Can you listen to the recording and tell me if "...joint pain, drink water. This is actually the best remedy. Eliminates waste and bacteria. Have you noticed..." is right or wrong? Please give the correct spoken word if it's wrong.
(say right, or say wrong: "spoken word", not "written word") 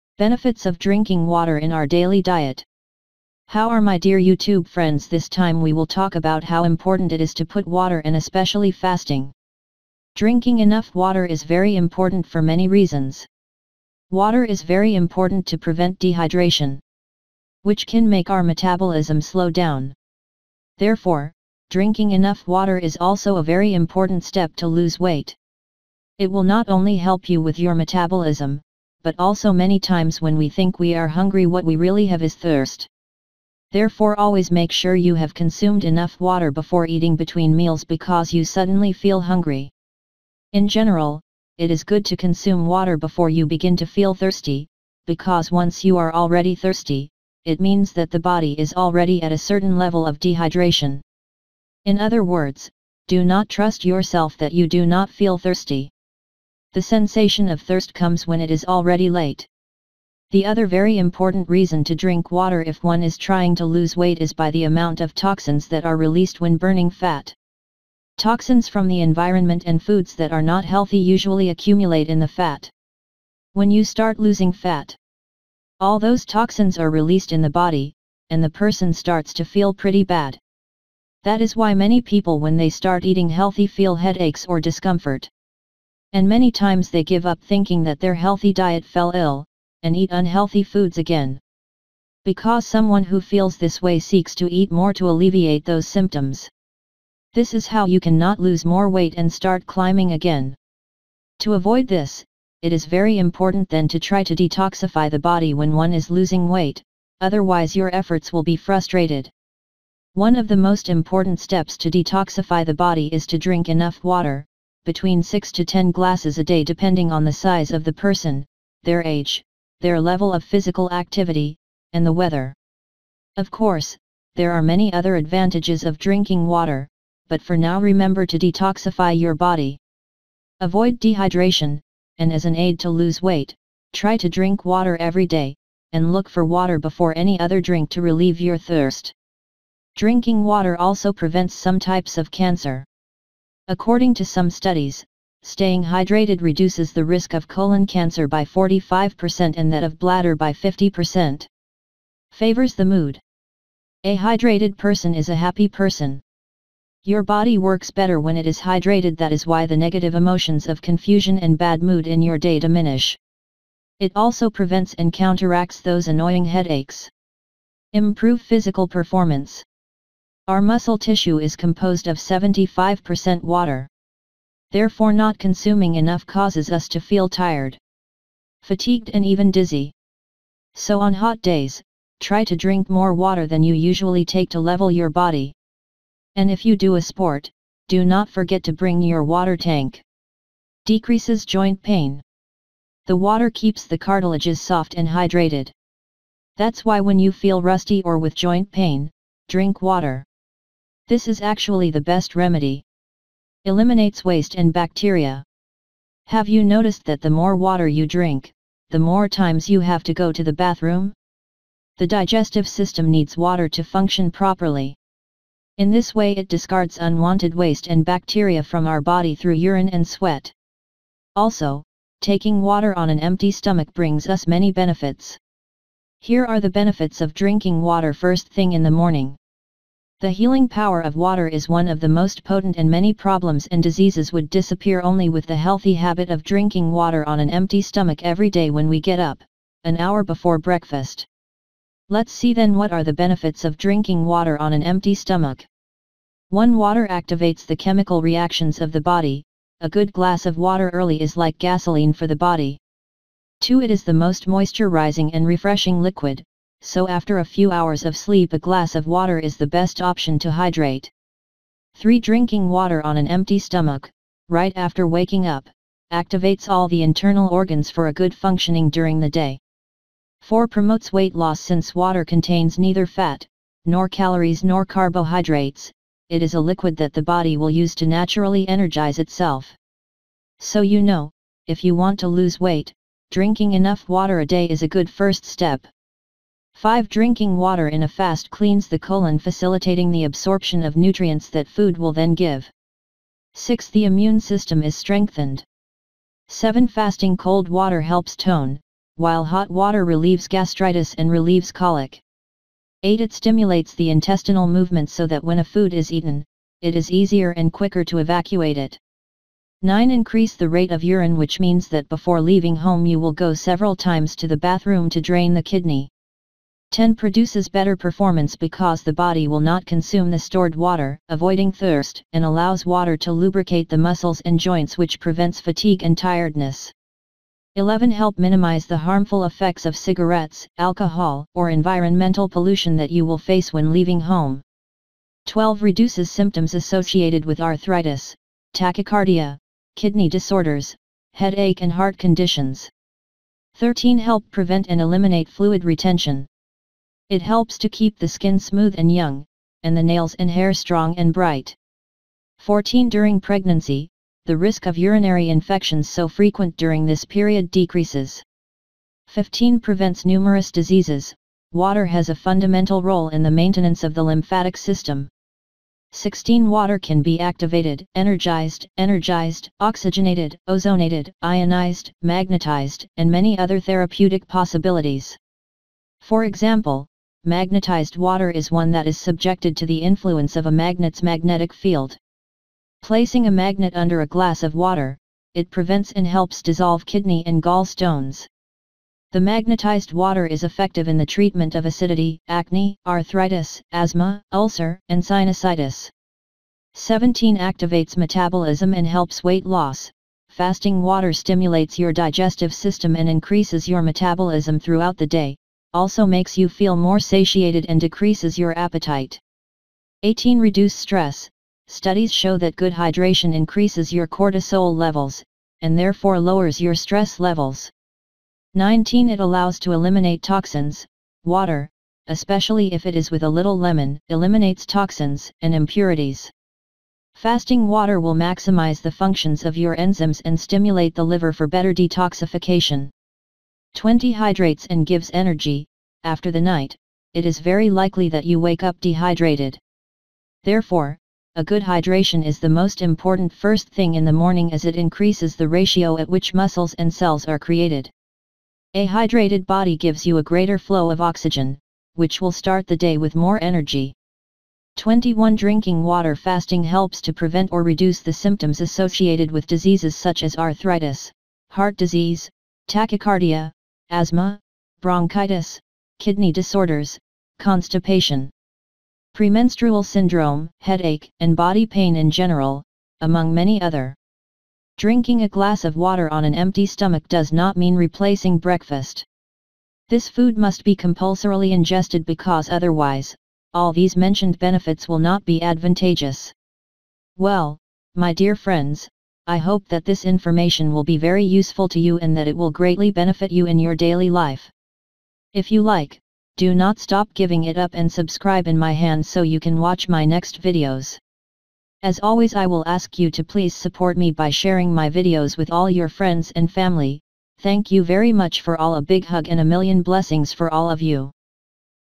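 right.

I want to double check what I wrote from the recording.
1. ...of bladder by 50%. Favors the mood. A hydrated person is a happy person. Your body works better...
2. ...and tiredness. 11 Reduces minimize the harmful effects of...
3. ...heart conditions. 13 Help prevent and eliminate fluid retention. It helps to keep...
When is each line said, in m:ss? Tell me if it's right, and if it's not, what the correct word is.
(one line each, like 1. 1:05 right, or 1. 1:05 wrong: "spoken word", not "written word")
1. 2:29 right
2. 5:26 wrong: "Help", not "Reduces"
3. 5:41 right.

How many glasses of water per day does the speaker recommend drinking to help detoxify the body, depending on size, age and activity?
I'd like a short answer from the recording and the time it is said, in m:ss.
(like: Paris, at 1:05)
6 to 10 glasses, at 1:55.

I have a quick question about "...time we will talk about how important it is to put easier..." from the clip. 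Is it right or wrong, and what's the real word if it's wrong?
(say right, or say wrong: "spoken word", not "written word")
wrong: "water", not "easier".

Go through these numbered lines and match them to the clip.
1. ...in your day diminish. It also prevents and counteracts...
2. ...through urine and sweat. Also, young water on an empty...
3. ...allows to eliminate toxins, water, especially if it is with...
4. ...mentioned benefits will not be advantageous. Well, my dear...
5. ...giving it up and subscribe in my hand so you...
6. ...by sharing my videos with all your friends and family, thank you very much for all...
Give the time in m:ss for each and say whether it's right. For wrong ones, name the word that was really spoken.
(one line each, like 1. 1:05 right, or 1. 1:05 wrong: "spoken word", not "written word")
1. 2:42 right
2. 3:39 wrong: "taking", not "young"
3. 6:59 right
4. 8:04 right
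5. 8:17 right
6. 8:24 right.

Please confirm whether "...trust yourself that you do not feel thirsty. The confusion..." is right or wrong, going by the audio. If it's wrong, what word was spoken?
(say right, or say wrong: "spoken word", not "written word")
wrong: "sensation", not "confusion".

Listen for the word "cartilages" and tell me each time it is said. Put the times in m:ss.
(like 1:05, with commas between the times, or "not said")
3:13.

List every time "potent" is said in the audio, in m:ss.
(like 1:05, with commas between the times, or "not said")
3:52.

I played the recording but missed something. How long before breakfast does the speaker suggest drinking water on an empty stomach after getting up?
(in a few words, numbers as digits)
An hour.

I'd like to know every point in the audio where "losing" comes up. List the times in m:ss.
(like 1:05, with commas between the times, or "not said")
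1:14, 1:46.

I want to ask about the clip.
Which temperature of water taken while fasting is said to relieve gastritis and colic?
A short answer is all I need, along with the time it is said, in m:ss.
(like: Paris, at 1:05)
Hot water, at 4:59.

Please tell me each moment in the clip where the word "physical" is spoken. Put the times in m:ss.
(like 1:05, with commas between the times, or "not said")
2:00, 2:48.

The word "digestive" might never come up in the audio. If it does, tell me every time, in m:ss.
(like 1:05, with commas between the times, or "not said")
3:32, 6:42.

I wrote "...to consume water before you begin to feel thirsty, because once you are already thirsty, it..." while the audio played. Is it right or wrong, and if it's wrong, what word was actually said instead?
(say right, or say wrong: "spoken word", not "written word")
right.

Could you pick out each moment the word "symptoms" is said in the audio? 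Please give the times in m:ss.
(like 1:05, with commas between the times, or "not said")
1:35, 5:36, 7:38.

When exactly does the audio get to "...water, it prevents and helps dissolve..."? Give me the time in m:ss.
6:24.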